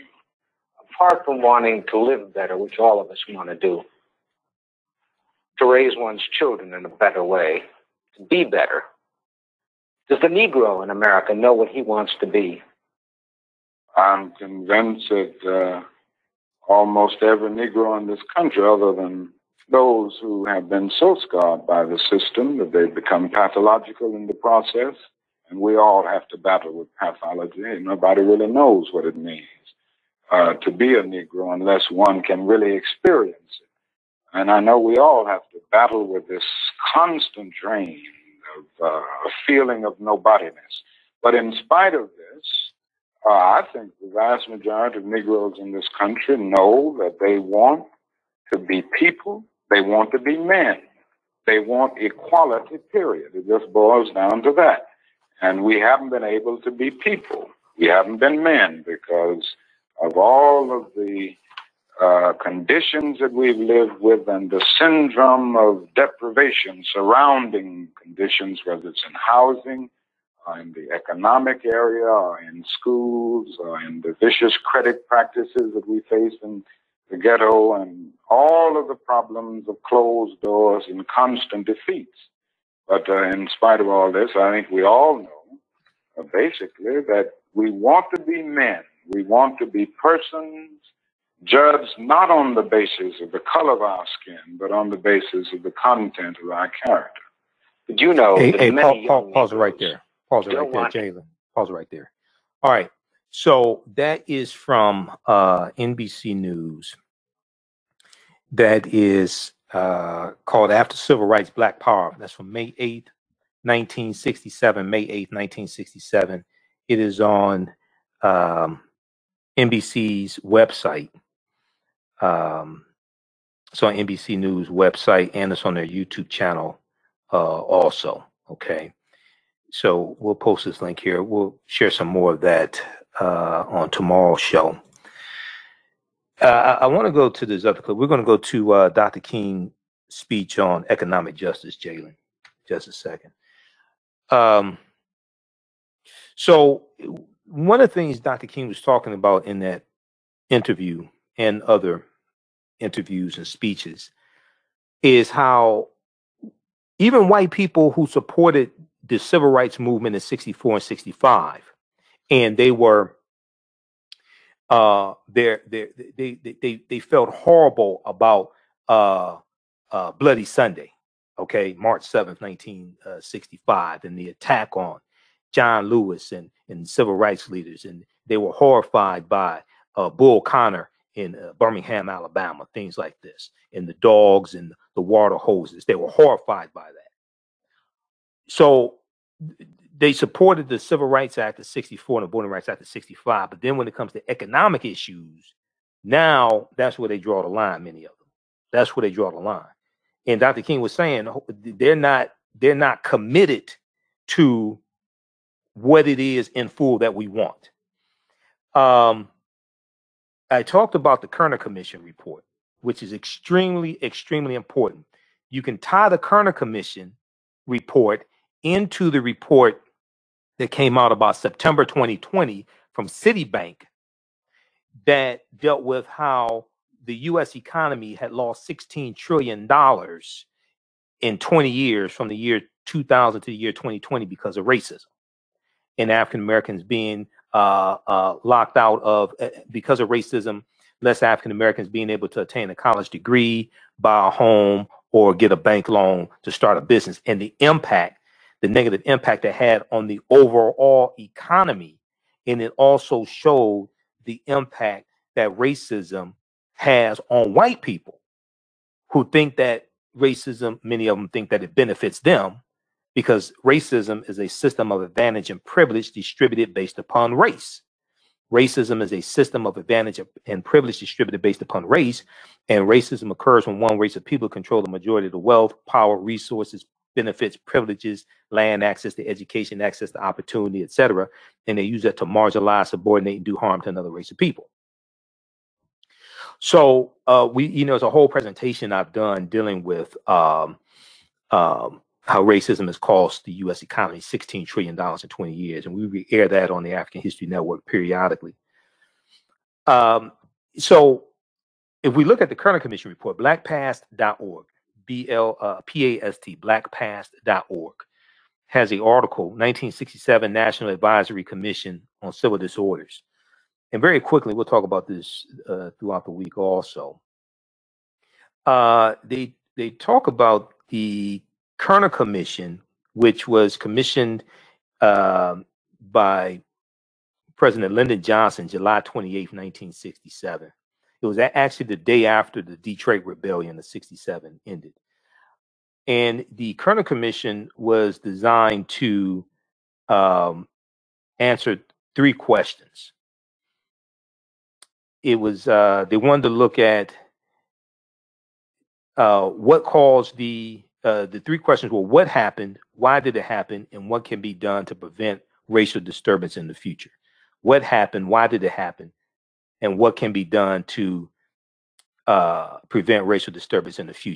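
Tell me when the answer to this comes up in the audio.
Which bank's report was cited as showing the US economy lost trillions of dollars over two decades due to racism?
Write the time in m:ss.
3:43.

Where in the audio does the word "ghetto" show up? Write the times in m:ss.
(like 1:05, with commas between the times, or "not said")
1:17.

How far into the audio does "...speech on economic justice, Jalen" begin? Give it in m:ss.
2:20.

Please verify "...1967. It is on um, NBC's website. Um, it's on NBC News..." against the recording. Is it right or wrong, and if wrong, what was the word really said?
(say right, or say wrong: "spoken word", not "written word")
right.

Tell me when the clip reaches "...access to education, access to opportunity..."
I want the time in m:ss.
4:38.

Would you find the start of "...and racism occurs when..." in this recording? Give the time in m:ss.
4:32.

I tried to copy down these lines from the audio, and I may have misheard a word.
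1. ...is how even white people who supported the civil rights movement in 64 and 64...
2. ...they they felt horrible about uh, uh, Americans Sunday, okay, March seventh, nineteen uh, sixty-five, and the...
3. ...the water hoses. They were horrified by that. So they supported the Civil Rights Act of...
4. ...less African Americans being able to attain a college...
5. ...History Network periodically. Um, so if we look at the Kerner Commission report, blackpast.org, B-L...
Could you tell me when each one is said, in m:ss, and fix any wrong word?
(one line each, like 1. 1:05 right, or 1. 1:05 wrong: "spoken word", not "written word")
1. 2:35 wrong: "65", not "64"
2. 2:46 wrong: "Bloody", not "Americans"
3. 3:04 right
4. 4:01 right
5. 4:57 right.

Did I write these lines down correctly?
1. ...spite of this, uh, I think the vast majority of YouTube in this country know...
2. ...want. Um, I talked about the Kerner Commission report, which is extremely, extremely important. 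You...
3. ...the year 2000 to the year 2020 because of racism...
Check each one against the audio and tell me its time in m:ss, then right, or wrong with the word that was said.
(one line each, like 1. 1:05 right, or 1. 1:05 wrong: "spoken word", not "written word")
1. 0:41 wrong: "Negroes", not "YouTube"
2. 3:27 right
3. 3:52 right.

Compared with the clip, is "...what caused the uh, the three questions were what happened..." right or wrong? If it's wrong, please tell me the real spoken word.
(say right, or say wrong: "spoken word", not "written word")
right.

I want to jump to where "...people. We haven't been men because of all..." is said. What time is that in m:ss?
0:56.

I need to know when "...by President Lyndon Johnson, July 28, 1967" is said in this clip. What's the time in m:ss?
5:26.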